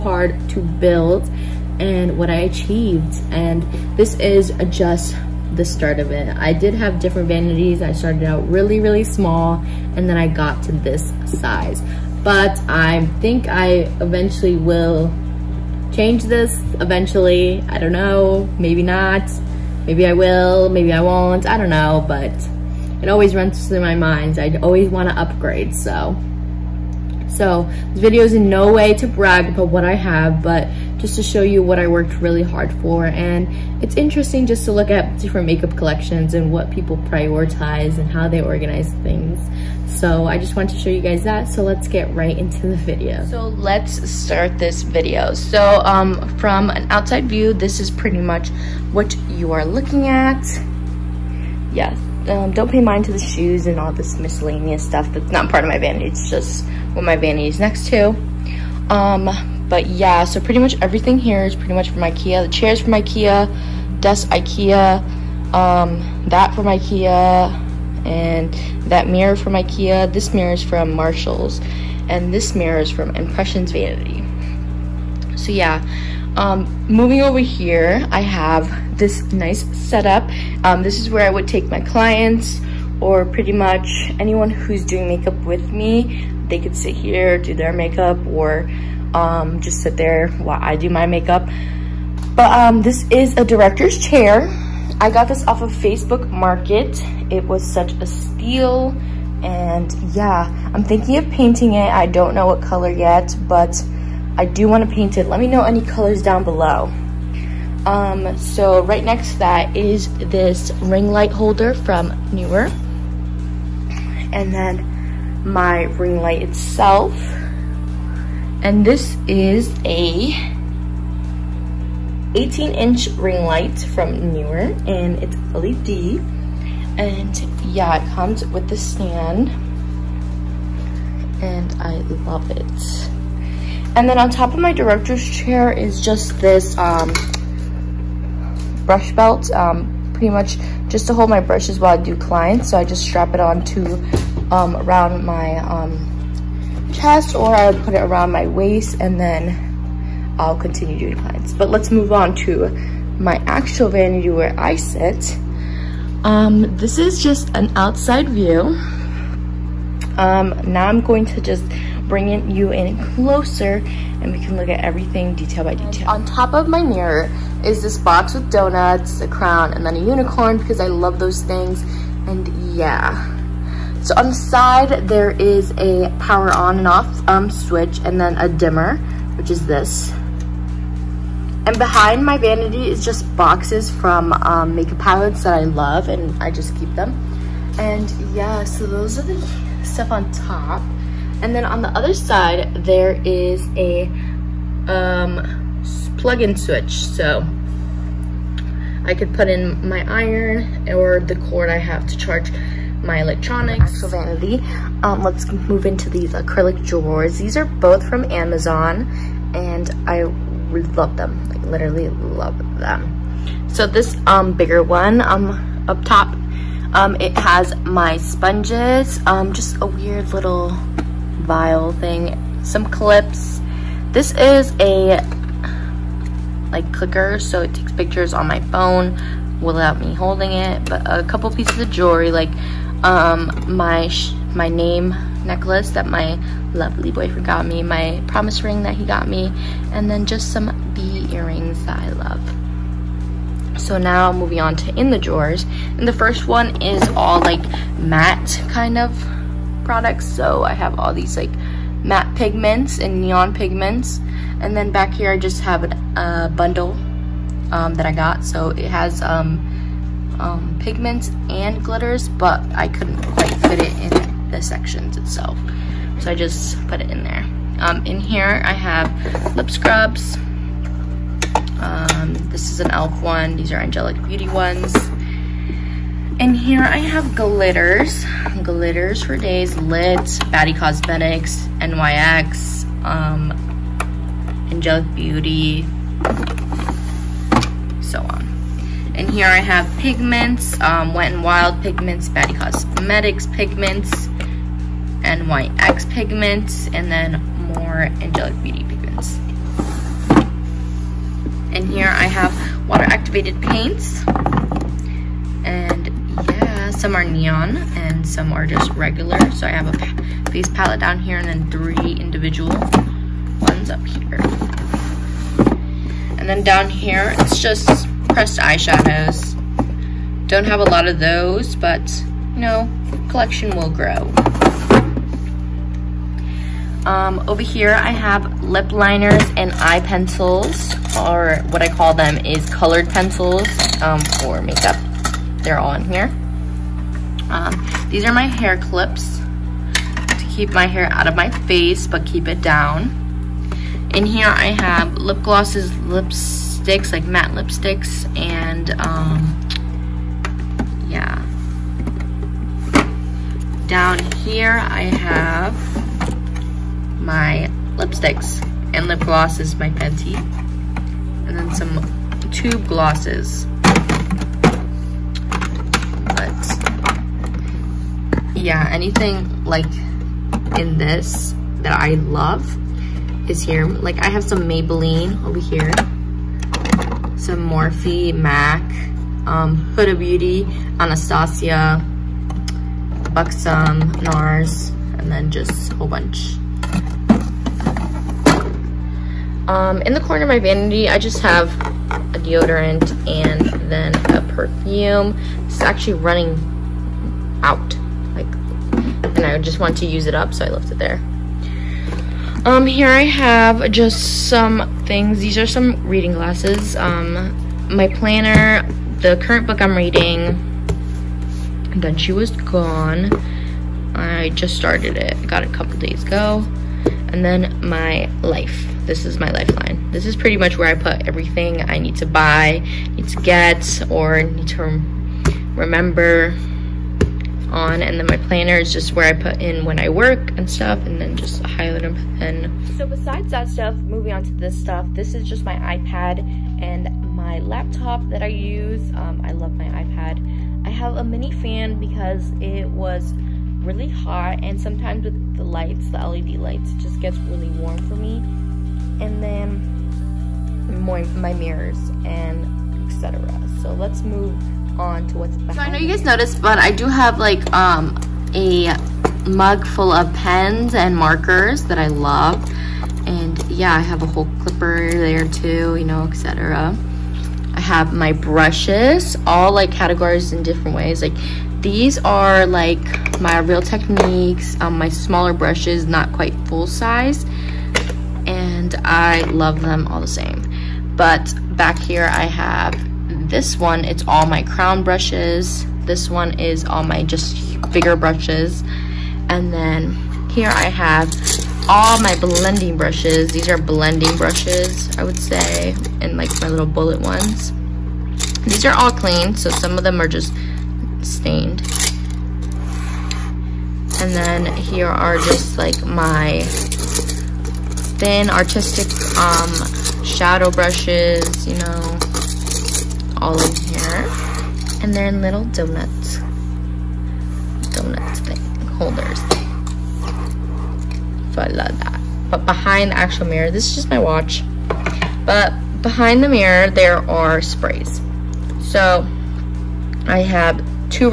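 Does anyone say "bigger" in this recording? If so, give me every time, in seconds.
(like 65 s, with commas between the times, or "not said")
214 s, 487 s.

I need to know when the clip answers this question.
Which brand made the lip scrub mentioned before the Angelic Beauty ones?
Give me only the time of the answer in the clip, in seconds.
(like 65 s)
272 s.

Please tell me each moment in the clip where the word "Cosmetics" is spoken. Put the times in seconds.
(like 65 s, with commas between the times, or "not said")
280 s, 292 s.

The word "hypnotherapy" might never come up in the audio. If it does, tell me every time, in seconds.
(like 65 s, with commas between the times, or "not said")
not said.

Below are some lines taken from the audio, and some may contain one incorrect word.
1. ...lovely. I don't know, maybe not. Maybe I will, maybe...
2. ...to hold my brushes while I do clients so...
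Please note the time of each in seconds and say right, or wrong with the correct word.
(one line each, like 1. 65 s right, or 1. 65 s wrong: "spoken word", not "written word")
1. 16 s wrong: "eventually", not "lovely"
2. 141 s right.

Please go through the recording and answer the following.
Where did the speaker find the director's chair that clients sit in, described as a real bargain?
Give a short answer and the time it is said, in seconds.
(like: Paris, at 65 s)
Facebook Market, at 95 s.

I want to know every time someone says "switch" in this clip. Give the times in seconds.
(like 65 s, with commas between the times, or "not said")
177 s, 196 s.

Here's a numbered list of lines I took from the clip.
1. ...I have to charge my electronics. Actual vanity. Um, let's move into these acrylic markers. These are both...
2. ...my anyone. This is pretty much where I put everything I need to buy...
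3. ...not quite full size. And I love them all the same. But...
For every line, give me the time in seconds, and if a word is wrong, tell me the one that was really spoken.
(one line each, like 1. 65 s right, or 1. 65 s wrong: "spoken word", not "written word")
1. 201 s wrong: "drawers", not "markers"
2. 419 s wrong: "lifeline", not "anyone"
3. 476 s right.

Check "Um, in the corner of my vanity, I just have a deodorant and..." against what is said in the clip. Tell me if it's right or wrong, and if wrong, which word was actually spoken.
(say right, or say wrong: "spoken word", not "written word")
right.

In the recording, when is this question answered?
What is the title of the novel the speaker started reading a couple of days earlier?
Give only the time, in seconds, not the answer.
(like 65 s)
411 s.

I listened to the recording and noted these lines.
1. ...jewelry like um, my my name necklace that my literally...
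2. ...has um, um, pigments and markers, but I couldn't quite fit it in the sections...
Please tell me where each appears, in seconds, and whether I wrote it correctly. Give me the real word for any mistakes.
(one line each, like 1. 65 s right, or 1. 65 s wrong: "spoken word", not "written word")
1. 231 s wrong: "lovely", not "literally"
2. 258 s wrong: "glitters", not "markers".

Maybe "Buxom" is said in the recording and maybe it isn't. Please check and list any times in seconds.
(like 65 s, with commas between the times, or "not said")
383 s.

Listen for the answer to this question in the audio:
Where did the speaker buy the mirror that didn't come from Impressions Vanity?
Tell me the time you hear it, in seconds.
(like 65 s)
70 s.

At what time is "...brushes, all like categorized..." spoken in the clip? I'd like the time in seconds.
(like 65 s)
468 s.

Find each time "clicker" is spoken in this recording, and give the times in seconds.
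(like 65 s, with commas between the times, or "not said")
226 s.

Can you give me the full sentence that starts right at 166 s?
And on top of my mirror is this box with donuts, a crown, and then a unicorn because I love those things.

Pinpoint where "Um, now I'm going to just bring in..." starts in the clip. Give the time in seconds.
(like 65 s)
160 s.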